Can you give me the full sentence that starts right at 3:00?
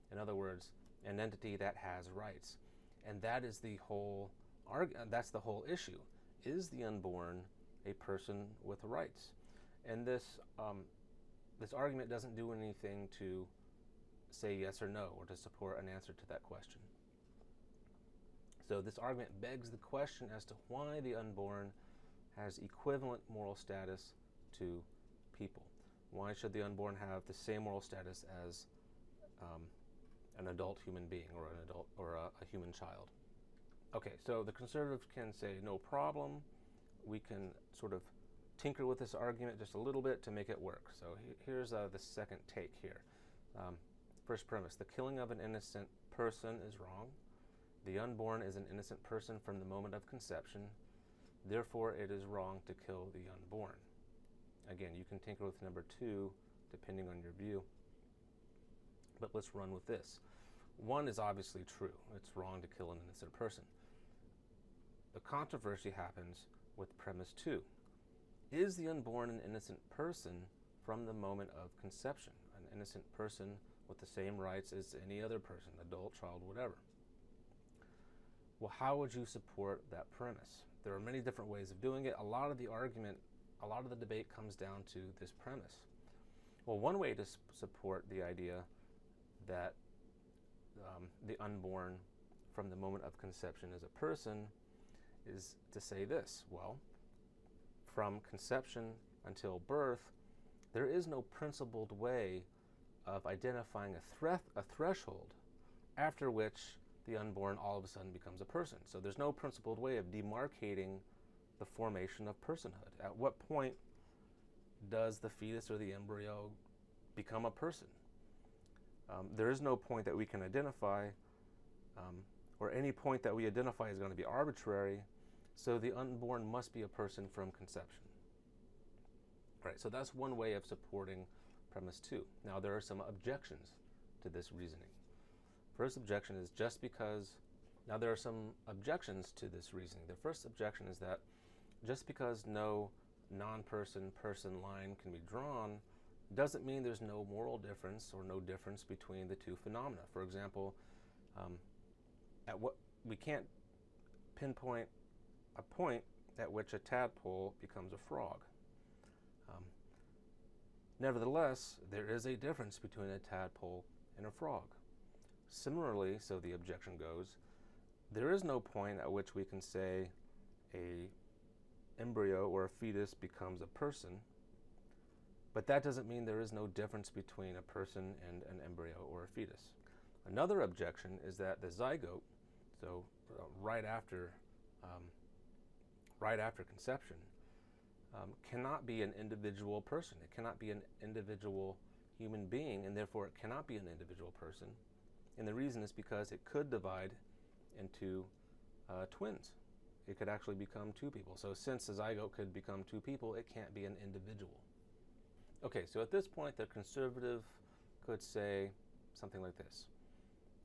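Another objection is that the zygote, so uh, right after, um, right after conception, um, cannot be an individual person.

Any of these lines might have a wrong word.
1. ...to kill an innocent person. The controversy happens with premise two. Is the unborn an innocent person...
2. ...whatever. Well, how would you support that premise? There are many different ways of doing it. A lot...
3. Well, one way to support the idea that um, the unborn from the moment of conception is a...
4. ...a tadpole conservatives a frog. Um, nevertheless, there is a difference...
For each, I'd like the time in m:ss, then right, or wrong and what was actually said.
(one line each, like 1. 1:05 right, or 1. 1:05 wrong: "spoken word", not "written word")
1. 1:02 right
2. 1:16 right
3. 1:26 right
4. 2:36 wrong: "becomes", not "conservatives".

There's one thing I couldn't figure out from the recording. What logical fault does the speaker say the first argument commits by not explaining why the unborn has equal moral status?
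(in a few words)
Begs the question.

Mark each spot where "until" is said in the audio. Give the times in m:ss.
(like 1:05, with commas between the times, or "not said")
1:39.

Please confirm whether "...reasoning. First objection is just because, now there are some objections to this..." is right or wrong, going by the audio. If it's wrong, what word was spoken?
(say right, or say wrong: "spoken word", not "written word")
right.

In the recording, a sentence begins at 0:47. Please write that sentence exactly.
The unborn is an innocent person from the moment of conception.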